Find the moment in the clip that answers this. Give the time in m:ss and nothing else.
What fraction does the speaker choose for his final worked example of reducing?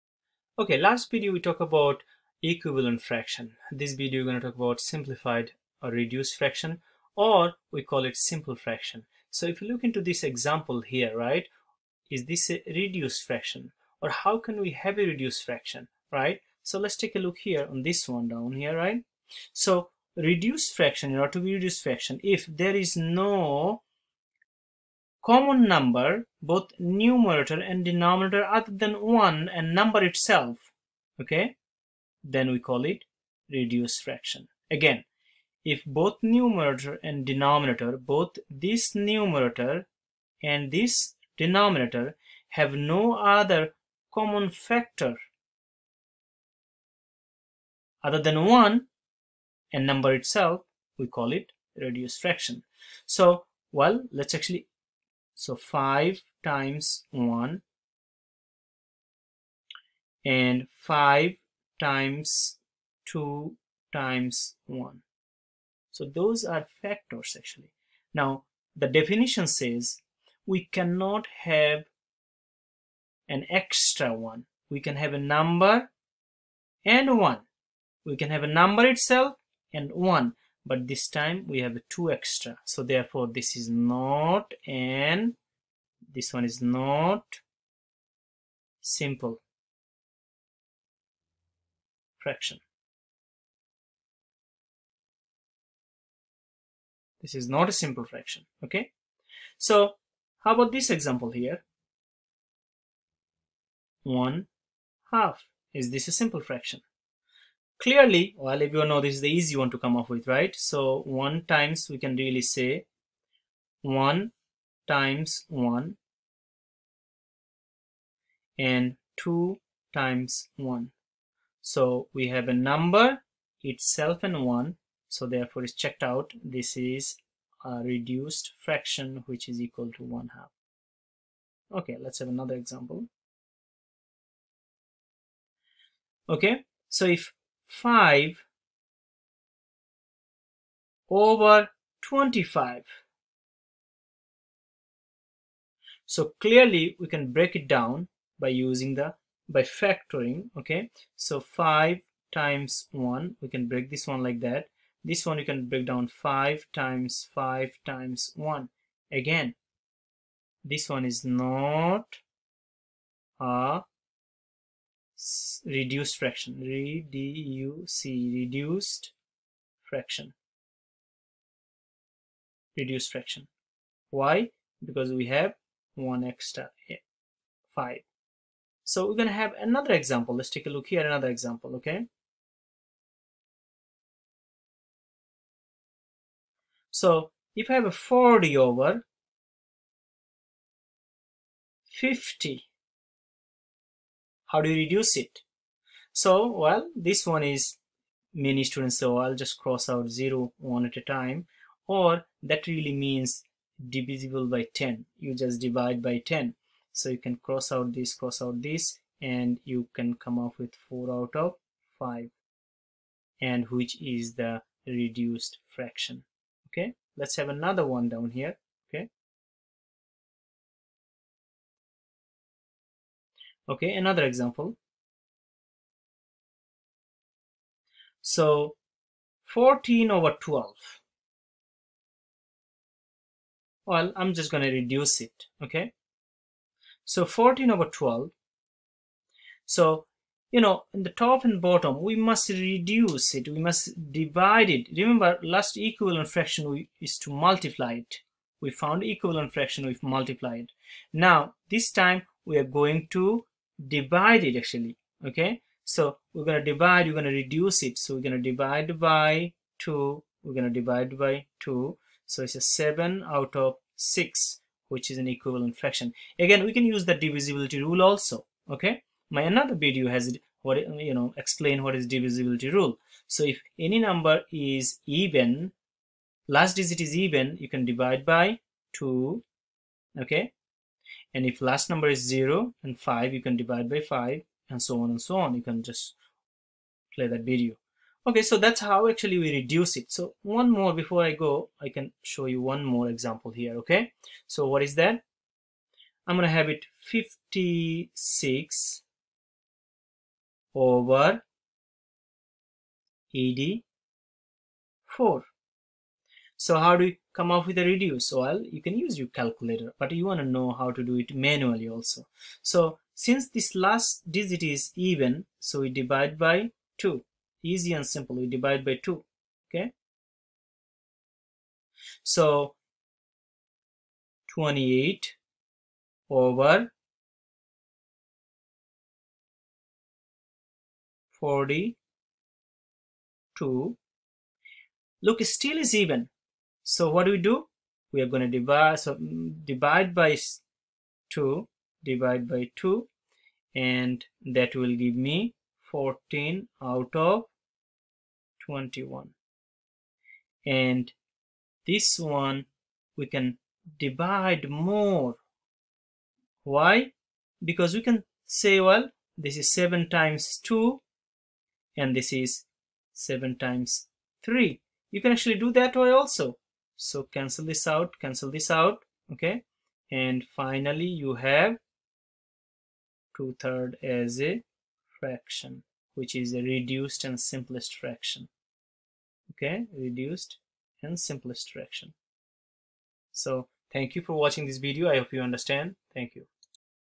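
4:57.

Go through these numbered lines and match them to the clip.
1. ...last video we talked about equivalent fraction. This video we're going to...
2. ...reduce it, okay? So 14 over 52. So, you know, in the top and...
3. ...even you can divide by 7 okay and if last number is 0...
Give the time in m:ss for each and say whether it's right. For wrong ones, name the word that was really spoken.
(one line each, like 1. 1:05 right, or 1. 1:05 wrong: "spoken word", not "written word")
1. 0:00 right
2. 3:54 wrong: "12", not "52"
3. 4:37 wrong: "2", not "7".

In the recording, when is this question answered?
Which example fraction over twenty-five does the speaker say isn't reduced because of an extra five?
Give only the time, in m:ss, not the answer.
2:17.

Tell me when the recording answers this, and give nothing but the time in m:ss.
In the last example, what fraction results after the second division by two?
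5:45.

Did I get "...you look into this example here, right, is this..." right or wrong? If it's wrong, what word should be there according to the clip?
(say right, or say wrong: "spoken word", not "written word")
right.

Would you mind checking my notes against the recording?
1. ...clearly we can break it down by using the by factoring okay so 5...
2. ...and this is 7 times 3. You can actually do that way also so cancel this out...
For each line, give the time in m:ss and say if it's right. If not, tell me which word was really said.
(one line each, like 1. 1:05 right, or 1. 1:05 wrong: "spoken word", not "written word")
1. 2:26 right
2. 6:01 right.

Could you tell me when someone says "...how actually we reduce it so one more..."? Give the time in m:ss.
4:48.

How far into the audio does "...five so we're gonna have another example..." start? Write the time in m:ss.
2:57.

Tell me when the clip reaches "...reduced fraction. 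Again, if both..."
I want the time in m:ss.
0:33.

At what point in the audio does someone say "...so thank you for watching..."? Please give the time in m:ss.
6:23.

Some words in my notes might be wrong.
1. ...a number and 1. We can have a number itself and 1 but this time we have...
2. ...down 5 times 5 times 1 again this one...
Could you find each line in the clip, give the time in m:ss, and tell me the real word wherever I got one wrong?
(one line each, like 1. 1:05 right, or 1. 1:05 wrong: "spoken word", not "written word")
1. 1:15 right
2. 2:35 right.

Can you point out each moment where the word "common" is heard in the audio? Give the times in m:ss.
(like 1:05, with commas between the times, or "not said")
0:25, 0:44.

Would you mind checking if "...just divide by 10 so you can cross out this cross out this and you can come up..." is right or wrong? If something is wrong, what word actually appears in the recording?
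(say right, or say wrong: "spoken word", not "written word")
right.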